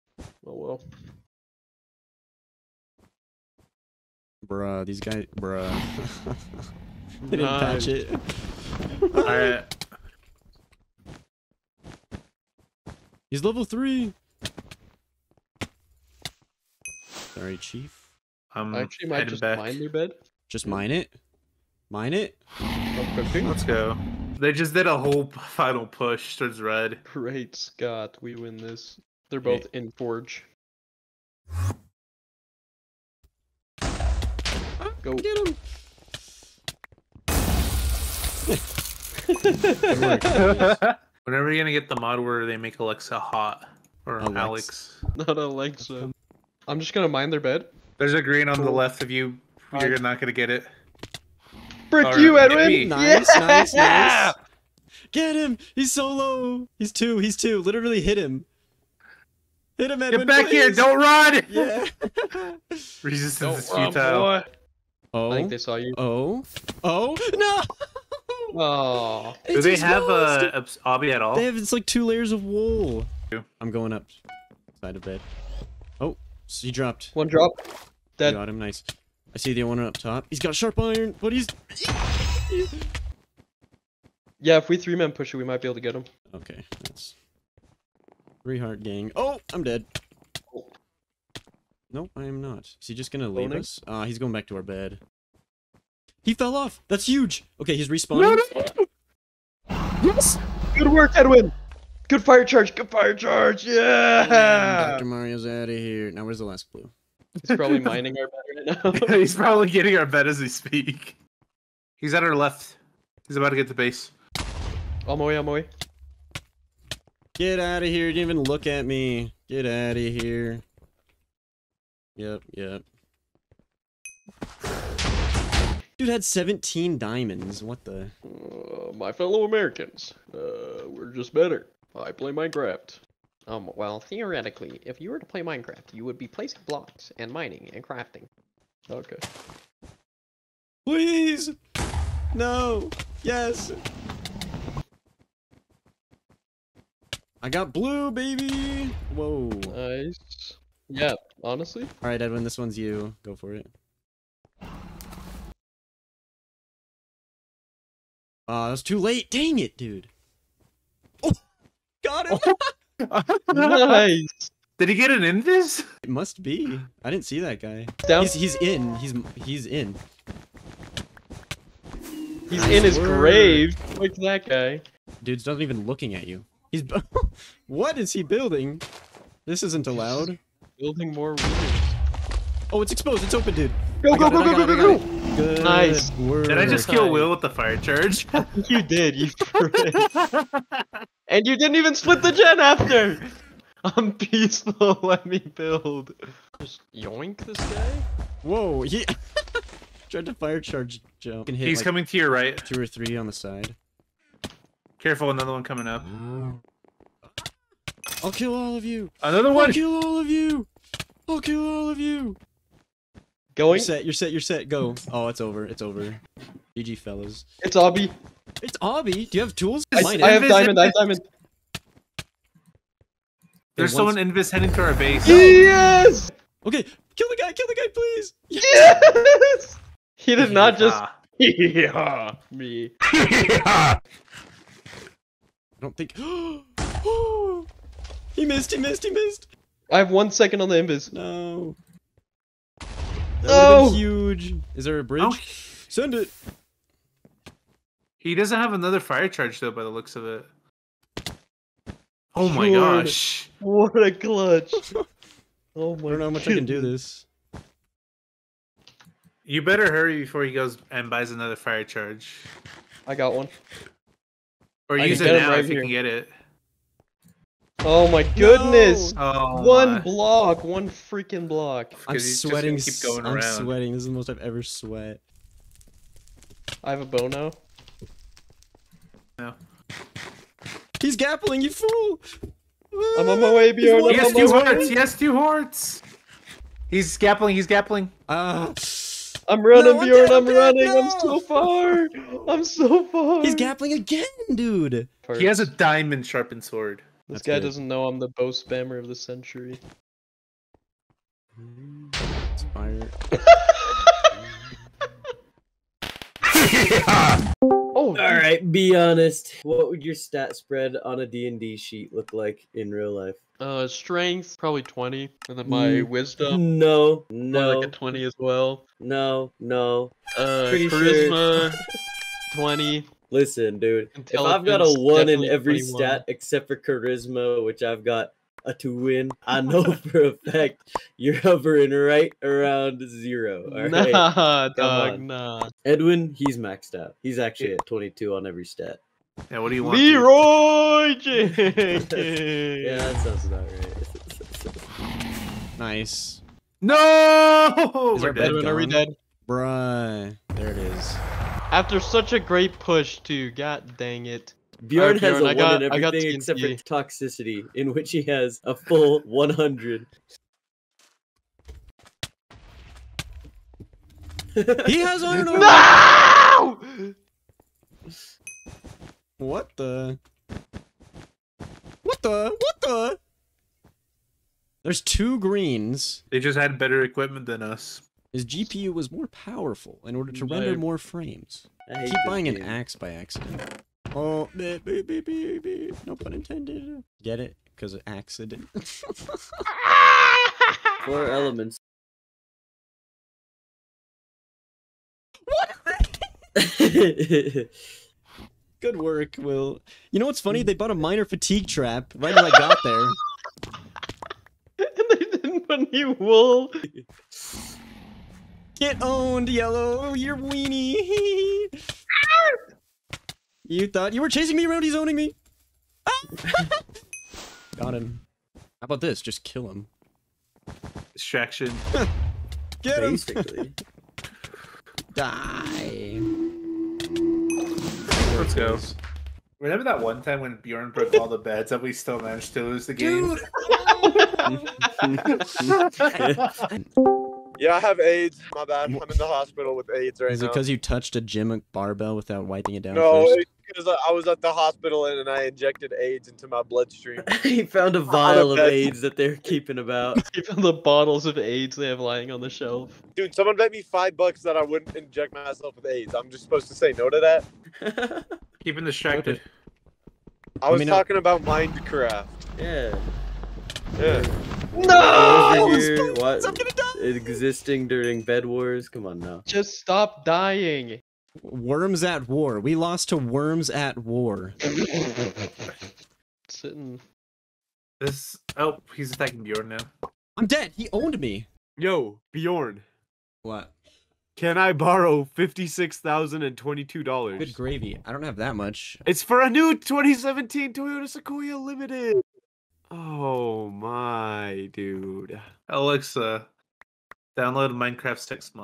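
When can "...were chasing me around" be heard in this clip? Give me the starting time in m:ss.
6:54.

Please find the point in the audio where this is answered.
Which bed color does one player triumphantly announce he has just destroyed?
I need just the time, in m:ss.
2:27.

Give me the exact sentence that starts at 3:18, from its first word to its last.
Whoa, he tried to fire charge jump.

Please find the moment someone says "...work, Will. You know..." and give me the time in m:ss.
6:38.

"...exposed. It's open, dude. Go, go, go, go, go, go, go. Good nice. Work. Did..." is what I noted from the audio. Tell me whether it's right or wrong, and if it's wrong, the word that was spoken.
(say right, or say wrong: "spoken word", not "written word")
right.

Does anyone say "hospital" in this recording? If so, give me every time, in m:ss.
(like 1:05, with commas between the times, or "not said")
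7:19, 7:24.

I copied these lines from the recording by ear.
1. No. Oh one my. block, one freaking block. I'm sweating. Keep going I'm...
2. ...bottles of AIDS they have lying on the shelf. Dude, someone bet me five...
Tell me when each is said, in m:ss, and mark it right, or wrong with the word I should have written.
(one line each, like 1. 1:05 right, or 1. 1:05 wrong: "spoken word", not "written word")
1. 4:29 right
2. 7:30 right.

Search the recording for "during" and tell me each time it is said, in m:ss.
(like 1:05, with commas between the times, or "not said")
7:47.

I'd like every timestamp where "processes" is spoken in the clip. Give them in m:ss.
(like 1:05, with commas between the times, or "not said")
not said.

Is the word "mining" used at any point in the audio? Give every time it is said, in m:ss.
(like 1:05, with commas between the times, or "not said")
1:47, 2:17.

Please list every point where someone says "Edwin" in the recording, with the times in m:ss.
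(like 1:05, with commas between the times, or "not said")
0:52, 1:00, 1:41, 2:32, 5:35.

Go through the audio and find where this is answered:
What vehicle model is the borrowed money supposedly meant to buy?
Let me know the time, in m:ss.
8:09.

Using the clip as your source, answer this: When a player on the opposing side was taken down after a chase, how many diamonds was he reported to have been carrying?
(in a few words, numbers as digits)
17.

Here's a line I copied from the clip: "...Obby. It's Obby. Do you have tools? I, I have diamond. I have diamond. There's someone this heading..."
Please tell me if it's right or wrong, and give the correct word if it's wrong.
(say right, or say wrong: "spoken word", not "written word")
right.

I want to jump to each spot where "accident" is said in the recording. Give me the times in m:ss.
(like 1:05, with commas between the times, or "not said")
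6:23, 6:28.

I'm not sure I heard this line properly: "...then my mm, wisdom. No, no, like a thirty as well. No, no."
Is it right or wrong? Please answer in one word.
wrong.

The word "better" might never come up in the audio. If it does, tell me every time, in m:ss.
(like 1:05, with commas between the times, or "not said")
2:11, 4:19, 6:16.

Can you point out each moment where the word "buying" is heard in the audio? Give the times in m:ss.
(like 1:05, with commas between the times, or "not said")
6:22.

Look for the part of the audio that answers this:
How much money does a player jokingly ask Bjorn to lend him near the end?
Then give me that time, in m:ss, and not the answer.
8:05.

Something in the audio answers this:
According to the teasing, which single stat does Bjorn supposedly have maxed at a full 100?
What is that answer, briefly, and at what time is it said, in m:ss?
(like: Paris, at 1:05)
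Toxicity, at 5:56.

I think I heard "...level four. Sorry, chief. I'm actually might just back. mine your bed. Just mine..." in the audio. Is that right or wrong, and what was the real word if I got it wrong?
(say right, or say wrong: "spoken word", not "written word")
wrong: "three", not "four".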